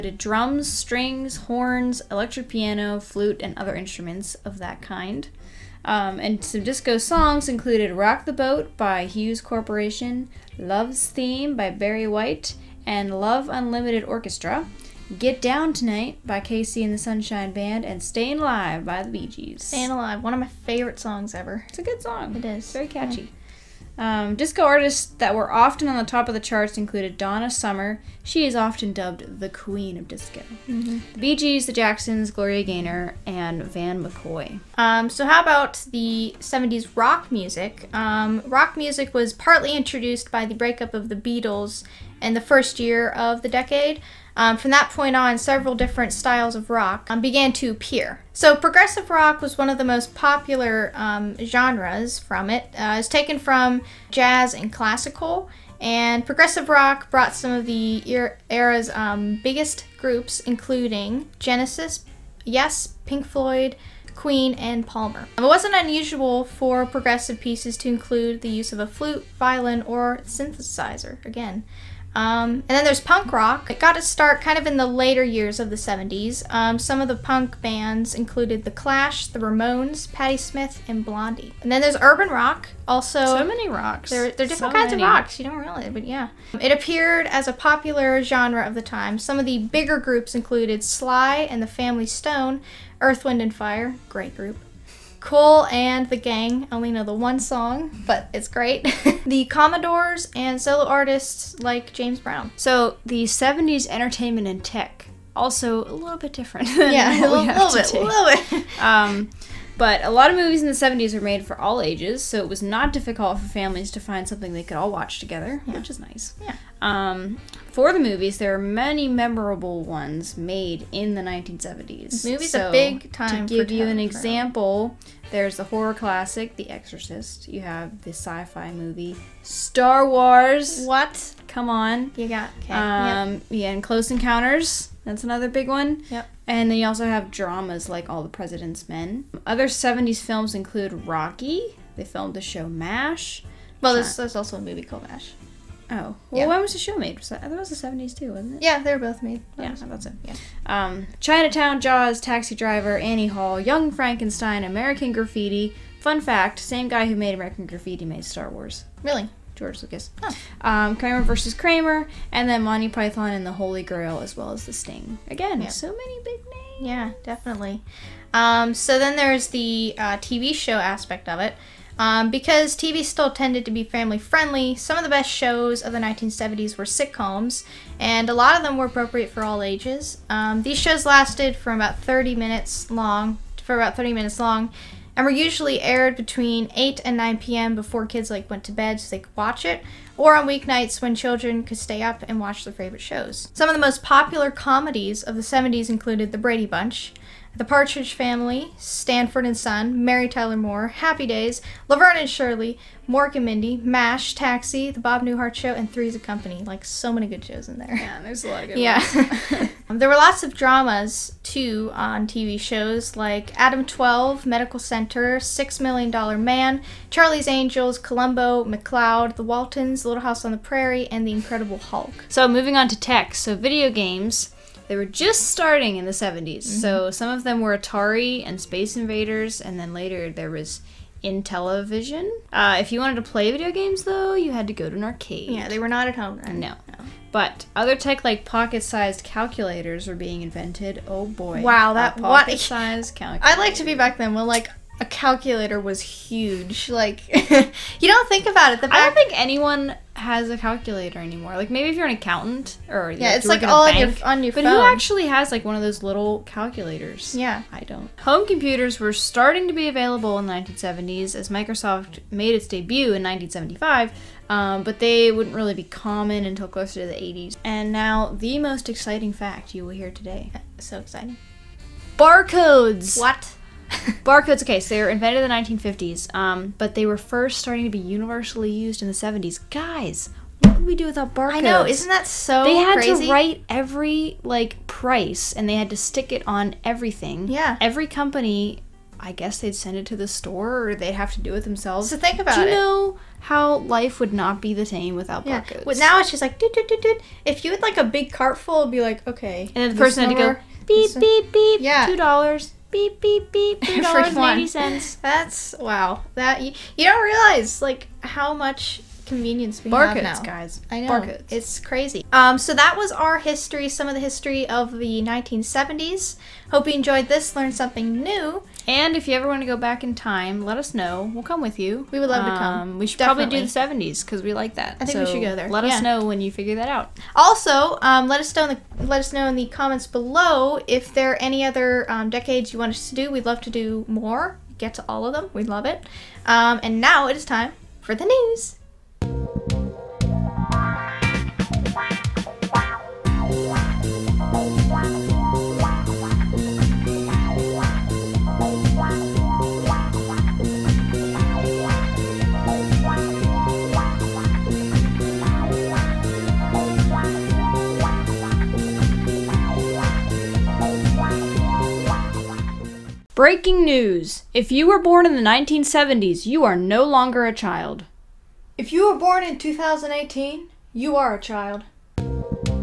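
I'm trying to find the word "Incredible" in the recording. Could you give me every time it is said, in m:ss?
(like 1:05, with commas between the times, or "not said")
3:41.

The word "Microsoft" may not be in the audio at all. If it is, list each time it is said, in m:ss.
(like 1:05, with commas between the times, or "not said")
4:21.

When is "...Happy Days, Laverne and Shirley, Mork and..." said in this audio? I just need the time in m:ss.
3:20.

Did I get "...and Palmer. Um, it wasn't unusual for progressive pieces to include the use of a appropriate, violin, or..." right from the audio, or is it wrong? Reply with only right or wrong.
wrong.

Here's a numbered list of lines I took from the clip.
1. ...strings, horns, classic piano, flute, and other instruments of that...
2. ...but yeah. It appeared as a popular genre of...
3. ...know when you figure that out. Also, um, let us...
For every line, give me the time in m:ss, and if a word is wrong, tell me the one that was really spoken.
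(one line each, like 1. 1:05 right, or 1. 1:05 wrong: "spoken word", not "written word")
1. 0:00 wrong: "electric", not "classic"
2. 1:25 right
3. 5:26 right.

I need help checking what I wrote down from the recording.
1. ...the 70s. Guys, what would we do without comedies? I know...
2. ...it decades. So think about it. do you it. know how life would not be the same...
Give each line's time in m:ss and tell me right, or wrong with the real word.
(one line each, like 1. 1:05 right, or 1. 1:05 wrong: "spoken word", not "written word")
1. 4:39 wrong: "barcodes", not "comedies"
2. 4:51 wrong: "themselves", not "decades".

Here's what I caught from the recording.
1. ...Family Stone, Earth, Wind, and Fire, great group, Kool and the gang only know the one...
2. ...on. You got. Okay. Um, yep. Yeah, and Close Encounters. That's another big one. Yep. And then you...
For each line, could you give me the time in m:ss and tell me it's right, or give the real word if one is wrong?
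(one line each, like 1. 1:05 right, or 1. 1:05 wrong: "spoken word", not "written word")
1. 1:31 right
2. 2:11 right.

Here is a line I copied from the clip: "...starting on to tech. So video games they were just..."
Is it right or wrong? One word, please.
wrong.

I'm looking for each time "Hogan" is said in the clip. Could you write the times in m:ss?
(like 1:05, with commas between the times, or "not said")
not said.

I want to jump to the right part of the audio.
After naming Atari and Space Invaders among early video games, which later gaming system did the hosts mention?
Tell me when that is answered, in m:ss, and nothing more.
3:51.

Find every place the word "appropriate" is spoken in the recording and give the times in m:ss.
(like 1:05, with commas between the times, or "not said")
2:58.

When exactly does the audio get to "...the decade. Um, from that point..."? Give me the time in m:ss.
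0:43.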